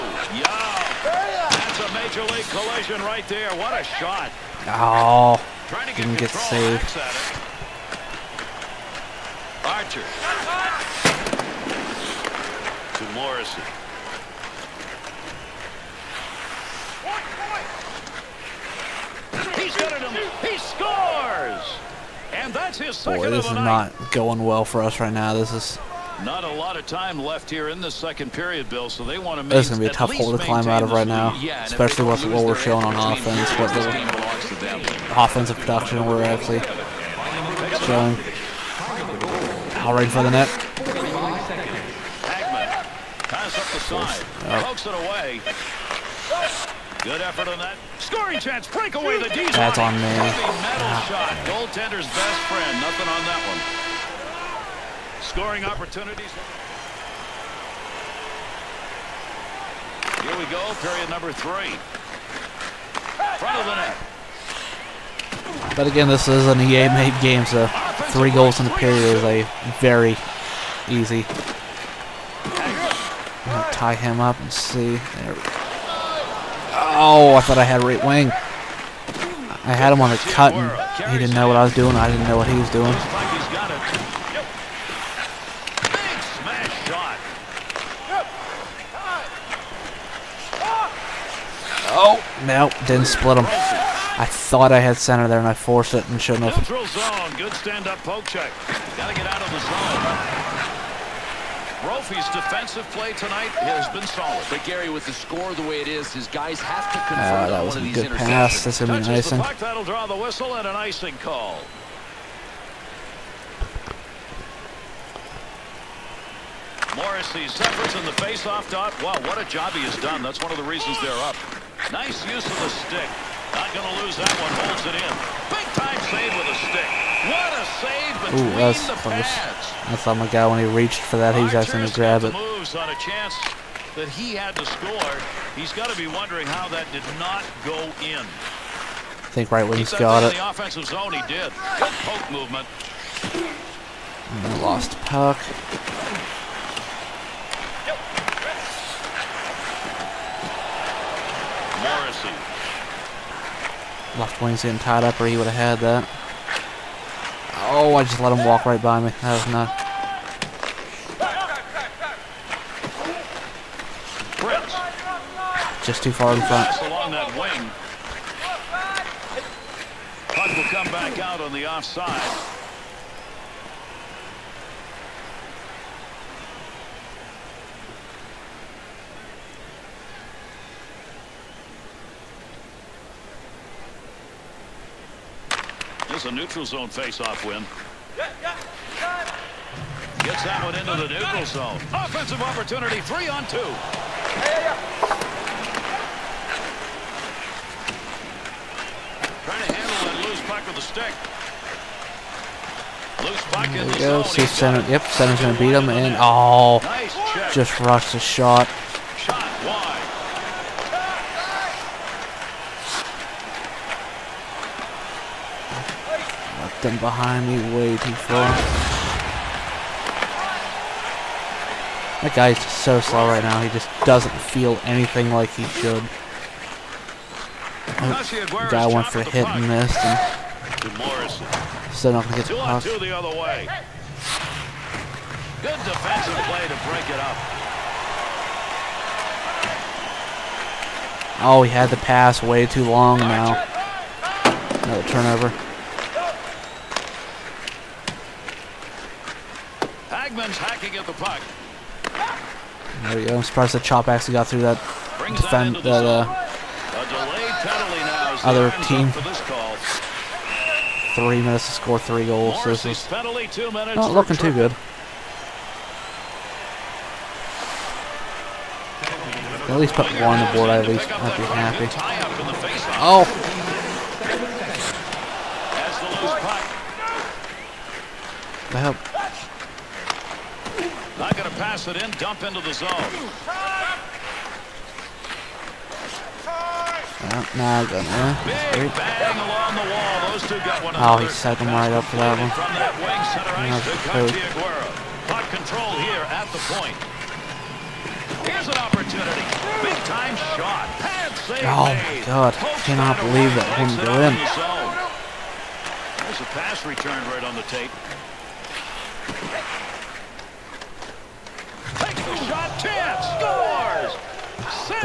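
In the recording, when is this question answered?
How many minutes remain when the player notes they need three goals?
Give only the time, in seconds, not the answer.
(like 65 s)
261 s.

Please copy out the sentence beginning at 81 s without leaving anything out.
I didn't know what he was doing.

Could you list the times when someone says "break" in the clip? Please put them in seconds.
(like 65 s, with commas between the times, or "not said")
48 s, 236 s.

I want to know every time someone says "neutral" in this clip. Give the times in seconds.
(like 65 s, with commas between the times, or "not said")
186 s, 191 s.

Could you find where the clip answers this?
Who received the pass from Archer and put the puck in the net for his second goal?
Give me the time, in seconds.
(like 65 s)
13 s.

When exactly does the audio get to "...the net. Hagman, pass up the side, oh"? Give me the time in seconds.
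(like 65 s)
40 s.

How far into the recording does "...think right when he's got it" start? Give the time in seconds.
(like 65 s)
139 s.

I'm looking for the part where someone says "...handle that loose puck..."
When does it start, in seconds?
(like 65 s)
199 s.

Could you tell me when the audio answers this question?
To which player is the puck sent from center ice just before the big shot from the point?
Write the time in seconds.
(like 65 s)
294 s.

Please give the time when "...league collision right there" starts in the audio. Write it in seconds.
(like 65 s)
2 s.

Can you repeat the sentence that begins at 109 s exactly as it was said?
Puck, that'll draw the whistle and an icing call.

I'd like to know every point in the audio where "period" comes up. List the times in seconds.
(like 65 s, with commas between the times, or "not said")
28 s, 60 s, 68 s.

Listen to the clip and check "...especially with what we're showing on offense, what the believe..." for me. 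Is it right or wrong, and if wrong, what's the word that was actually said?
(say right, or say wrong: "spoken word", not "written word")
wrong: "offensive", not "believe".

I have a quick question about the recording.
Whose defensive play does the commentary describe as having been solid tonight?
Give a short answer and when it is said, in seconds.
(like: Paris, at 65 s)
Brophy, at 101 s.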